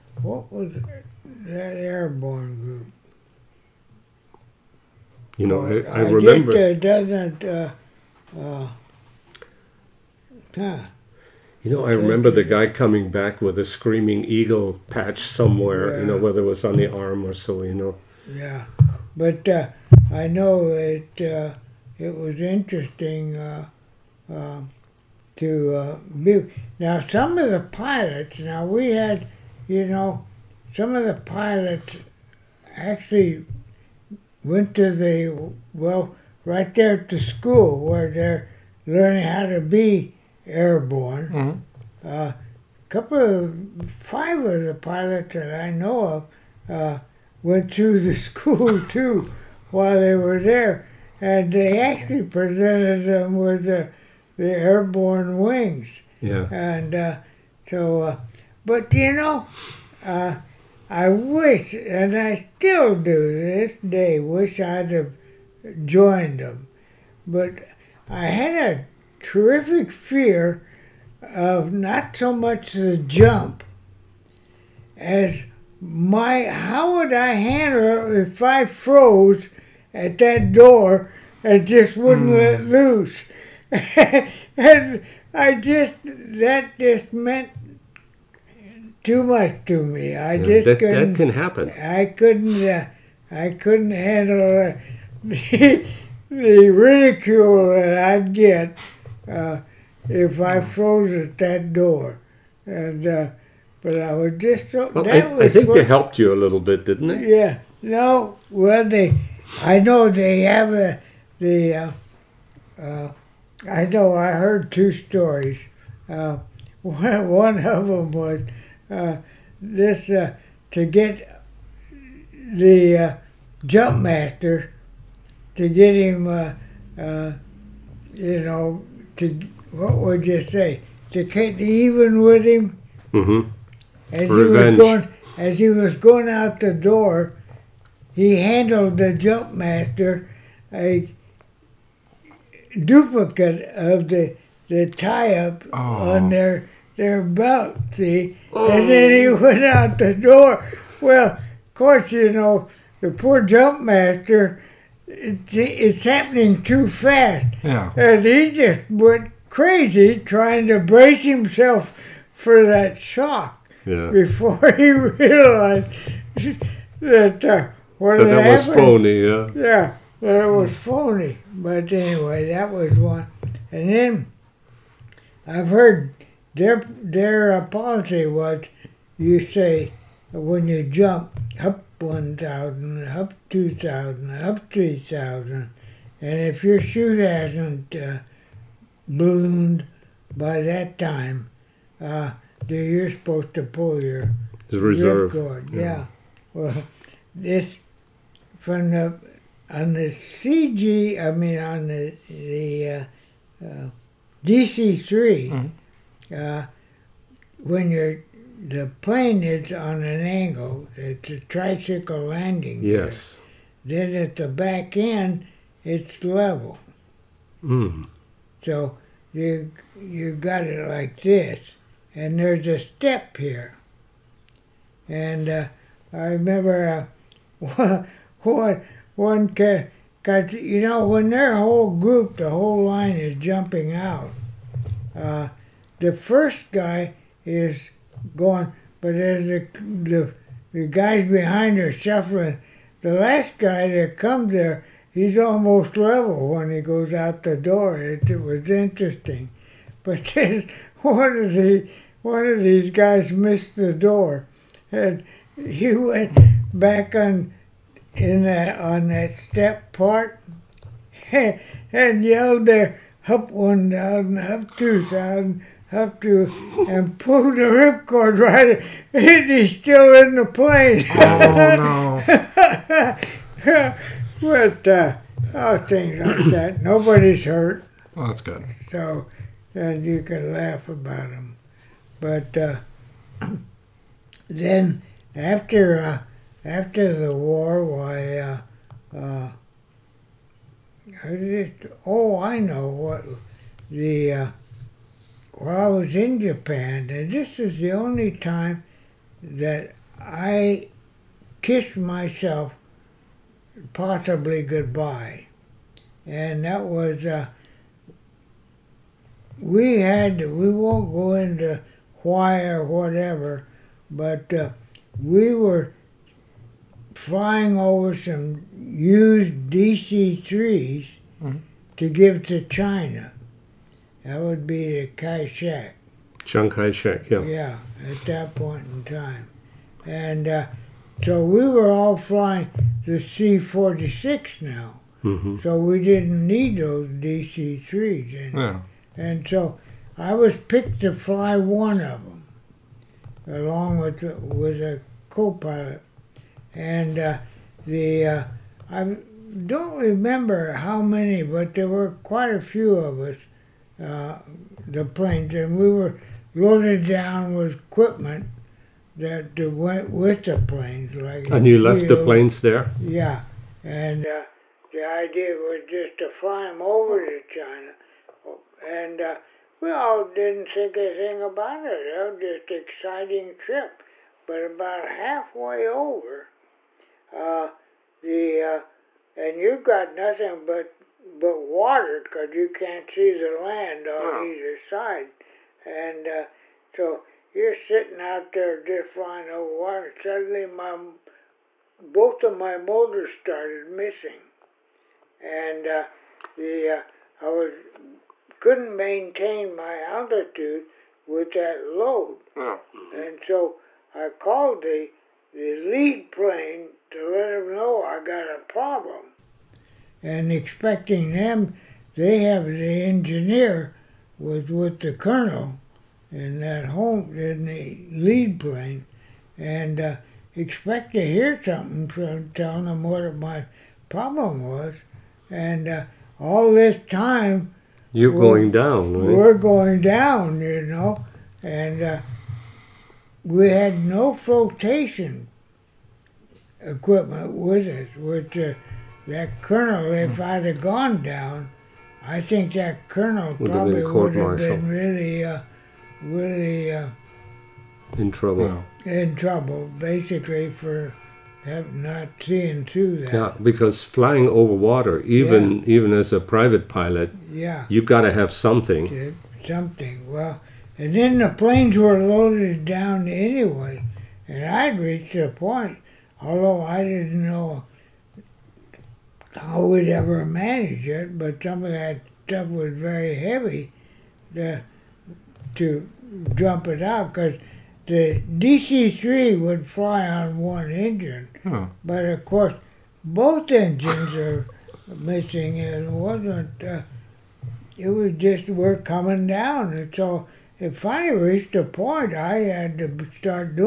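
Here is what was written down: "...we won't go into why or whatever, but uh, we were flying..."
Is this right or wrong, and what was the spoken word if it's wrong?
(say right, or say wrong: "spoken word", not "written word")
right.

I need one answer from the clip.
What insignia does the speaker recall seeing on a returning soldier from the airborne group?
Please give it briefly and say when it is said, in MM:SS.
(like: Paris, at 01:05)
Screaming eagle patch, at 00:13.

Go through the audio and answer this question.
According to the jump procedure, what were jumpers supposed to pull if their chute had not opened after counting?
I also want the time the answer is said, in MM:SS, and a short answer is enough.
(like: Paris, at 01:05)
Reserve cord, at 03:14.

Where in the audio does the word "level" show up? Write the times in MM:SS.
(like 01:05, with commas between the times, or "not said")
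03:36, 04:05.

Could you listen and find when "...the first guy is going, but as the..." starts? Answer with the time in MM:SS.
03:55.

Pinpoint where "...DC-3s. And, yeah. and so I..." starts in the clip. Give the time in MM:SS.
05:37.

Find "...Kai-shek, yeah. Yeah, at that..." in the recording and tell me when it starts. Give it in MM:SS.
05:26.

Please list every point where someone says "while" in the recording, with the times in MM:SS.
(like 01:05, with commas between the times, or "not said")
00:49, 04:55.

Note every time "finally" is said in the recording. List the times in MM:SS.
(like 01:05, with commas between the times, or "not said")
08:10.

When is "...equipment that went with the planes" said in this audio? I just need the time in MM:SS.
05:57.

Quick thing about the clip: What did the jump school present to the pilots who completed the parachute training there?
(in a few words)
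Airborne wings.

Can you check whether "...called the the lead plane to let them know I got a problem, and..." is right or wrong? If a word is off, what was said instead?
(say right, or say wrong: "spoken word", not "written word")
right.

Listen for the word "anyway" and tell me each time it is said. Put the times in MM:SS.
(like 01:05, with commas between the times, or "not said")
02:51, 07:43.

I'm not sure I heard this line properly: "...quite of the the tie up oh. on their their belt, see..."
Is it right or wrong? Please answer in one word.
wrong.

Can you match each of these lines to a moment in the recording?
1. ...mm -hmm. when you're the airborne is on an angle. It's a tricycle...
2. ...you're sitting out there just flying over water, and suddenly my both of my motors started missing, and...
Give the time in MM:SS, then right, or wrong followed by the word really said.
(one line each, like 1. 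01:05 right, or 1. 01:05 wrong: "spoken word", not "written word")
1. 03:25 wrong: "plane", not "airborne"
2. 06:27 right.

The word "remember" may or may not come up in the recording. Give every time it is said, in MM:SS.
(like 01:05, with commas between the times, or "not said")
00:06, 00:11, 03:46, 05:50.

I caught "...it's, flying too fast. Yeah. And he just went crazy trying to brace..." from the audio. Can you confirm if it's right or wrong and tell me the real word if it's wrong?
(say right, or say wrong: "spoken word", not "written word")
wrong: "happening", not "flying".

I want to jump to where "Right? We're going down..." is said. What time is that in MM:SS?
07:09.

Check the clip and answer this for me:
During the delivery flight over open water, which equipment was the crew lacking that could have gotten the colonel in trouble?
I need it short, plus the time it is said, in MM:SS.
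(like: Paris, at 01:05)
Flotation equipment, at 07:14.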